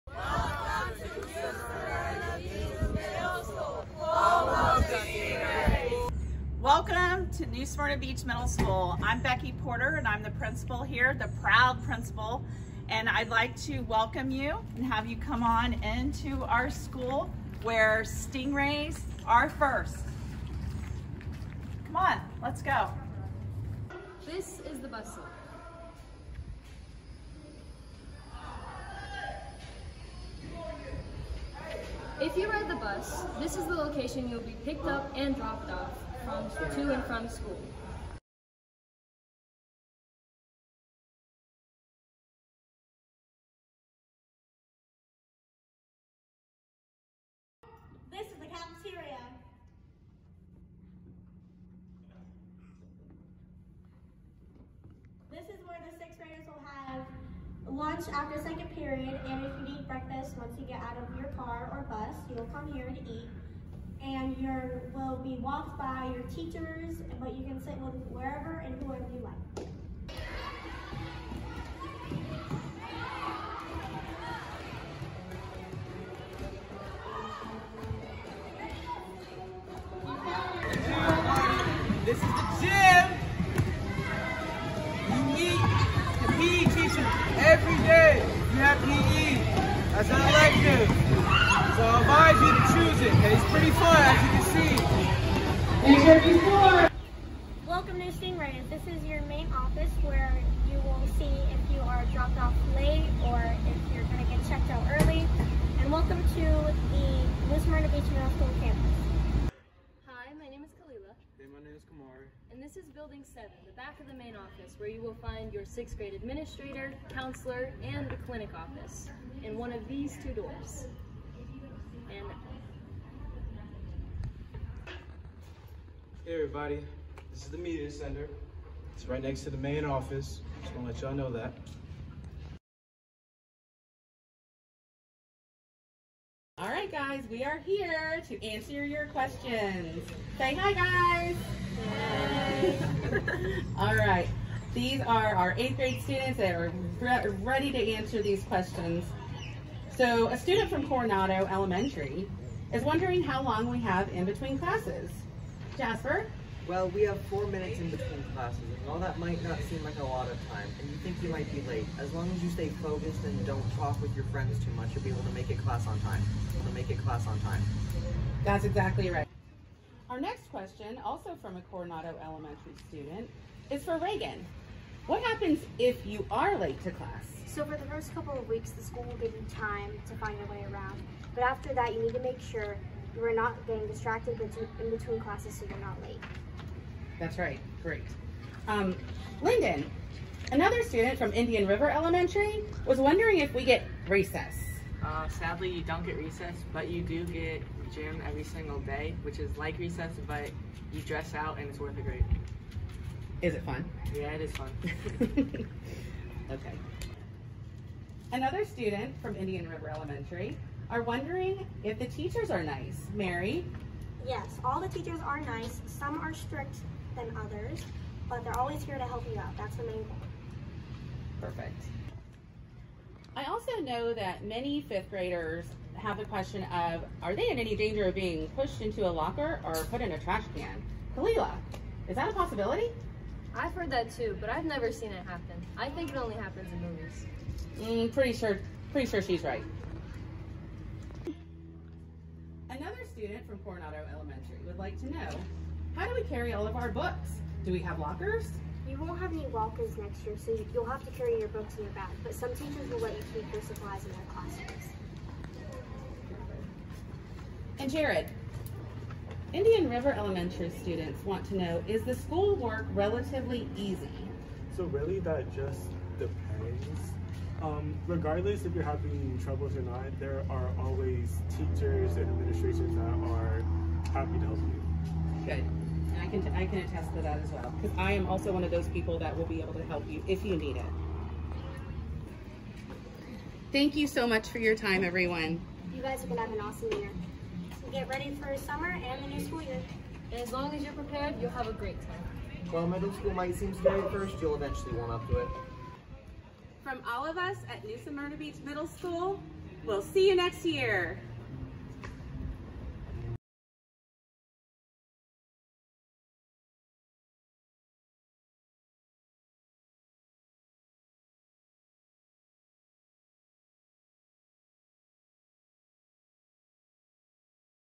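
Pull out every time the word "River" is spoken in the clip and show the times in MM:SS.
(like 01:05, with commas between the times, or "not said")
03:11, 03:29, 04:19.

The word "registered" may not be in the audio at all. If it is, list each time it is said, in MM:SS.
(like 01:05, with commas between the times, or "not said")
not said.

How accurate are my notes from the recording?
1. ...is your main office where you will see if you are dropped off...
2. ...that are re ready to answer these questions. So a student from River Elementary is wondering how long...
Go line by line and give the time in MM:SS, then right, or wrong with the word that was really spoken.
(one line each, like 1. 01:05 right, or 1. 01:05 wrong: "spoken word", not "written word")
1. 01:38 right
2. 02:26 wrong: "Coronado", not "River".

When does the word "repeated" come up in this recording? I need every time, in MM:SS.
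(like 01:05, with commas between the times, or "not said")
not said.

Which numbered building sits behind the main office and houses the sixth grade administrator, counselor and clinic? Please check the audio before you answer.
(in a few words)
Building 7.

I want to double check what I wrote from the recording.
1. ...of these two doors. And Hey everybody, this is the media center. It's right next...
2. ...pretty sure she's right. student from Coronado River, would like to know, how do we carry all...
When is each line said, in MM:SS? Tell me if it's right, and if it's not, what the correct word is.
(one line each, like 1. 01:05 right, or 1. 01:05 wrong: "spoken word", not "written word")
1. 01:59 right
2. 03:58 wrong: "Elementary", not "River".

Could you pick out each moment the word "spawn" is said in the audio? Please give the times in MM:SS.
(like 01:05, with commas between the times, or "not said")
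not said.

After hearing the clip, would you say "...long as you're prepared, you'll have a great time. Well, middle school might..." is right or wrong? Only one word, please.
right.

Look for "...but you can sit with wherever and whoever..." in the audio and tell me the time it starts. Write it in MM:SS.
01:07.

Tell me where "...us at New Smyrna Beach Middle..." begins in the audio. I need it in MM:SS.
04:57.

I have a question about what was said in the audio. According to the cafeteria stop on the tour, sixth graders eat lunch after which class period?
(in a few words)
second period.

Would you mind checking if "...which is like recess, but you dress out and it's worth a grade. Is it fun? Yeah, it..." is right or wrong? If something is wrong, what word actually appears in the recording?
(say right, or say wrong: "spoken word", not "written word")
right.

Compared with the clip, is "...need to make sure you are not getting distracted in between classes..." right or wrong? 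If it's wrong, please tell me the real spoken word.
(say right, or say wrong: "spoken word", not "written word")
right.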